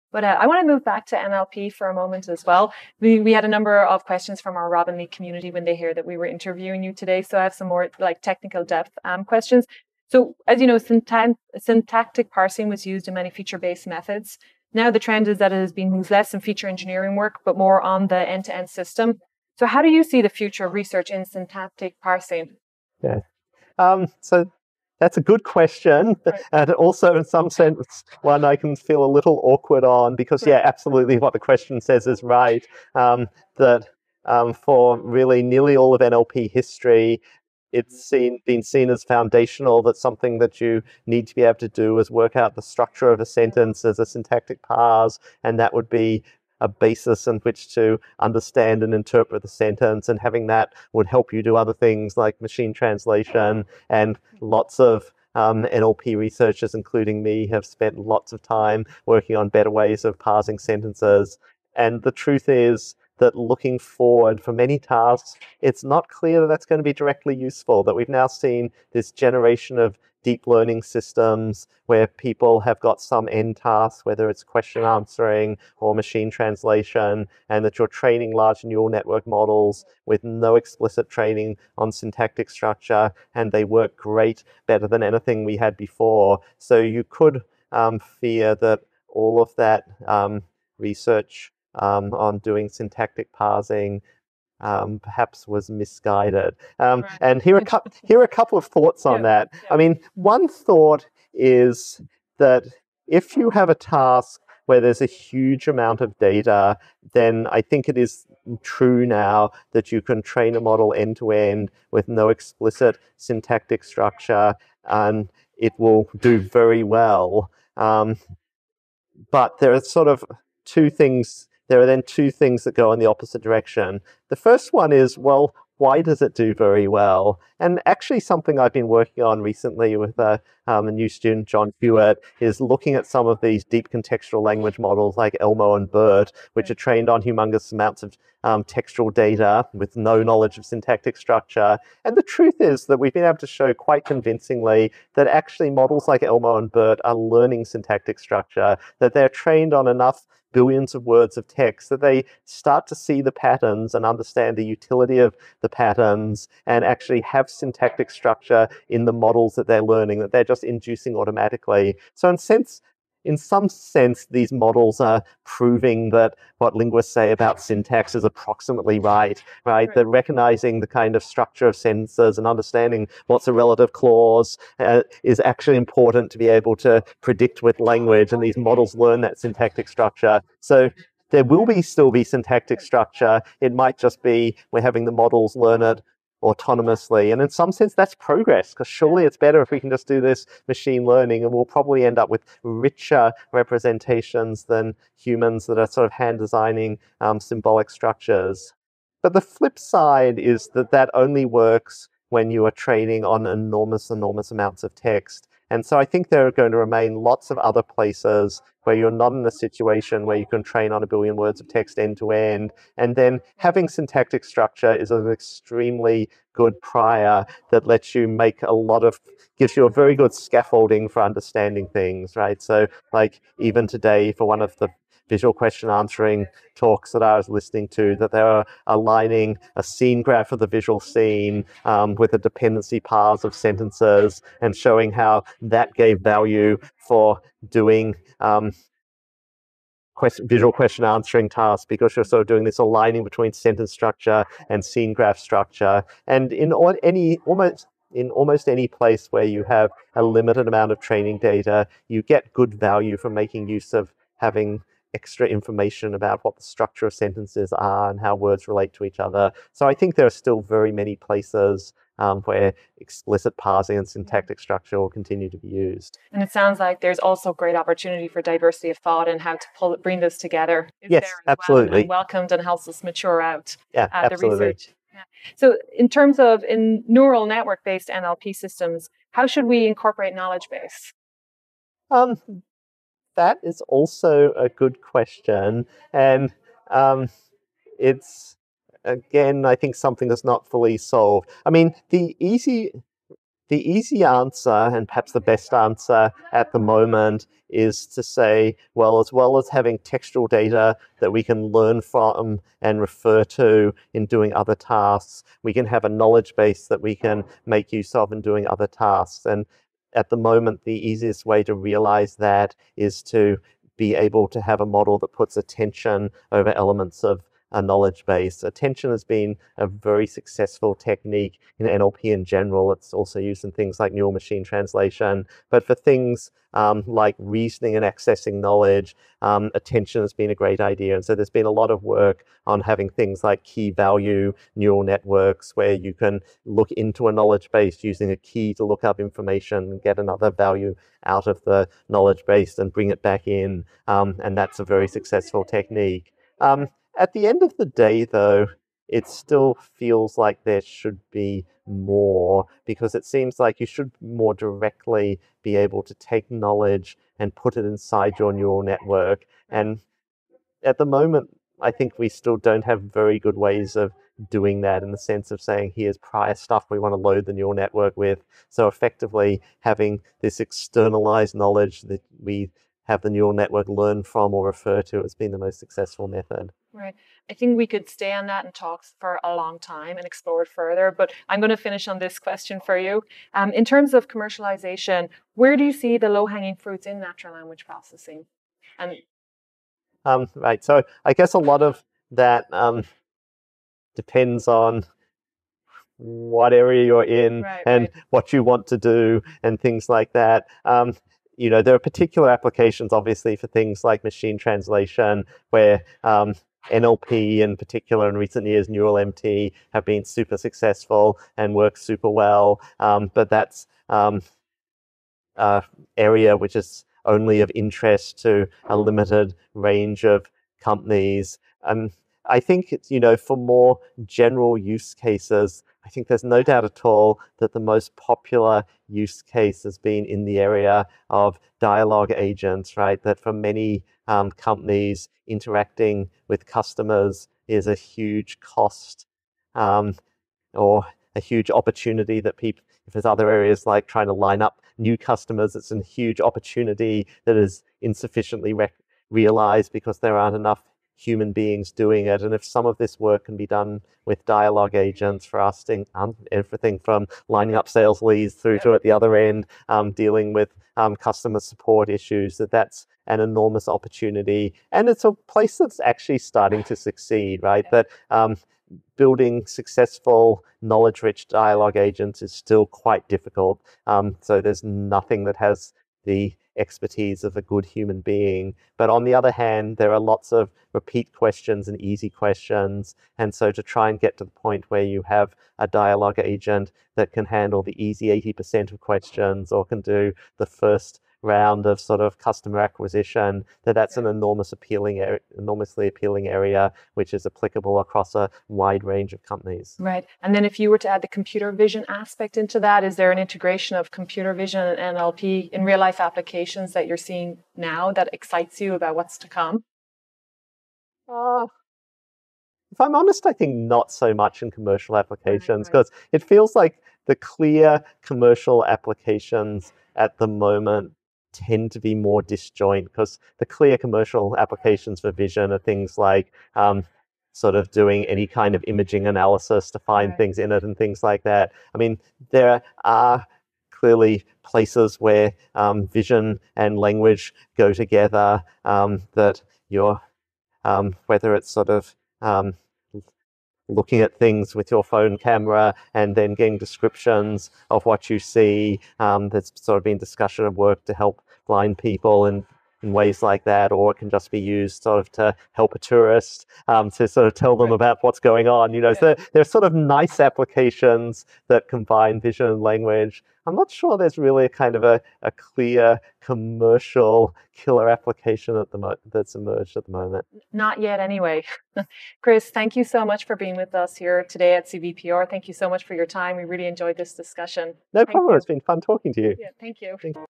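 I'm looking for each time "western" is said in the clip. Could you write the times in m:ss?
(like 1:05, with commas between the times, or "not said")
not said.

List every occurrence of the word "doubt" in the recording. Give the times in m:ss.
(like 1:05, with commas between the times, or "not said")
7:06.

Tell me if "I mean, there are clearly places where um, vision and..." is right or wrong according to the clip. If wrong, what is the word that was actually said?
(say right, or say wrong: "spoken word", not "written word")
right.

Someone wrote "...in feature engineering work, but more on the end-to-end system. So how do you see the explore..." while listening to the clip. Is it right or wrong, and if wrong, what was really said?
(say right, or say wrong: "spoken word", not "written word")
wrong: "future", not "explore".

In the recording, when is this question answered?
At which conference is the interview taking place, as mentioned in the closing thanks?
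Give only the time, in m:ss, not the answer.
9:34.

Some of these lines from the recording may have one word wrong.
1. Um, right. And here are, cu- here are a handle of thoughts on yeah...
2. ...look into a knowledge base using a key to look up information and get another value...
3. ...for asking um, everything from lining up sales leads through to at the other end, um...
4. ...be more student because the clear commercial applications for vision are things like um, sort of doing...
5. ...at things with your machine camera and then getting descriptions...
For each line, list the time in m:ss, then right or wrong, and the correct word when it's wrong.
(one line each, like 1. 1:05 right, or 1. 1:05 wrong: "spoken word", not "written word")
1. 1:36 wrong: "couple", not "handle"
2. 5:36 right
3. 7:35 right
4. 8:41 wrong: "disjoint", not "student"
5. 9:04 wrong: "phone", not "machine".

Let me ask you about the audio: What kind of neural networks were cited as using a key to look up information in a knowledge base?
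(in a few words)
key value neural networks.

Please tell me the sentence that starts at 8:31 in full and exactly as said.
Uh, if I'm honest, I think not so much in commercial applications because right.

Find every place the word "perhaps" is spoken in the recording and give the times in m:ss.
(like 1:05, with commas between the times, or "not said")
1:34, 4:55.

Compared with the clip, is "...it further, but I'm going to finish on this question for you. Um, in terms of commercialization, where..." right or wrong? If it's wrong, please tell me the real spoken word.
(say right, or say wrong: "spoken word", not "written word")
right.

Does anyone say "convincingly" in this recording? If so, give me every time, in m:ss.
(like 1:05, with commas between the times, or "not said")
2:24.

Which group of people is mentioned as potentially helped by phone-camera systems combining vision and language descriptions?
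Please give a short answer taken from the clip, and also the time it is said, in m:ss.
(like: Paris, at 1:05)
blind people, at 9:11.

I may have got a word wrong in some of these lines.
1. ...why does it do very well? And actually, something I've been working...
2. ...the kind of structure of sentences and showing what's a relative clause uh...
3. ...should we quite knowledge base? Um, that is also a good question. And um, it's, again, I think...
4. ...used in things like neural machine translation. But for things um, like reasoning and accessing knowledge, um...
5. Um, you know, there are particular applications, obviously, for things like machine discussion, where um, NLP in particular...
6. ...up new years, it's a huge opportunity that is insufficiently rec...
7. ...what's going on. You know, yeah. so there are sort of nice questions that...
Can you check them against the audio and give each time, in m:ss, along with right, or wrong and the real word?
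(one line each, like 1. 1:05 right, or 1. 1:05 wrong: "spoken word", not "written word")
1. 2:05 right
2. 2:50 wrong: "understanding", not "showing"
3. 4:39 wrong: "incorporate", not "quite"
4. 5:23 right
5. 6:40 wrong: "translation", not "discussion"
6. 7:24 wrong: "customers", not "years"
7. 9:18 wrong: "applications", not "questions".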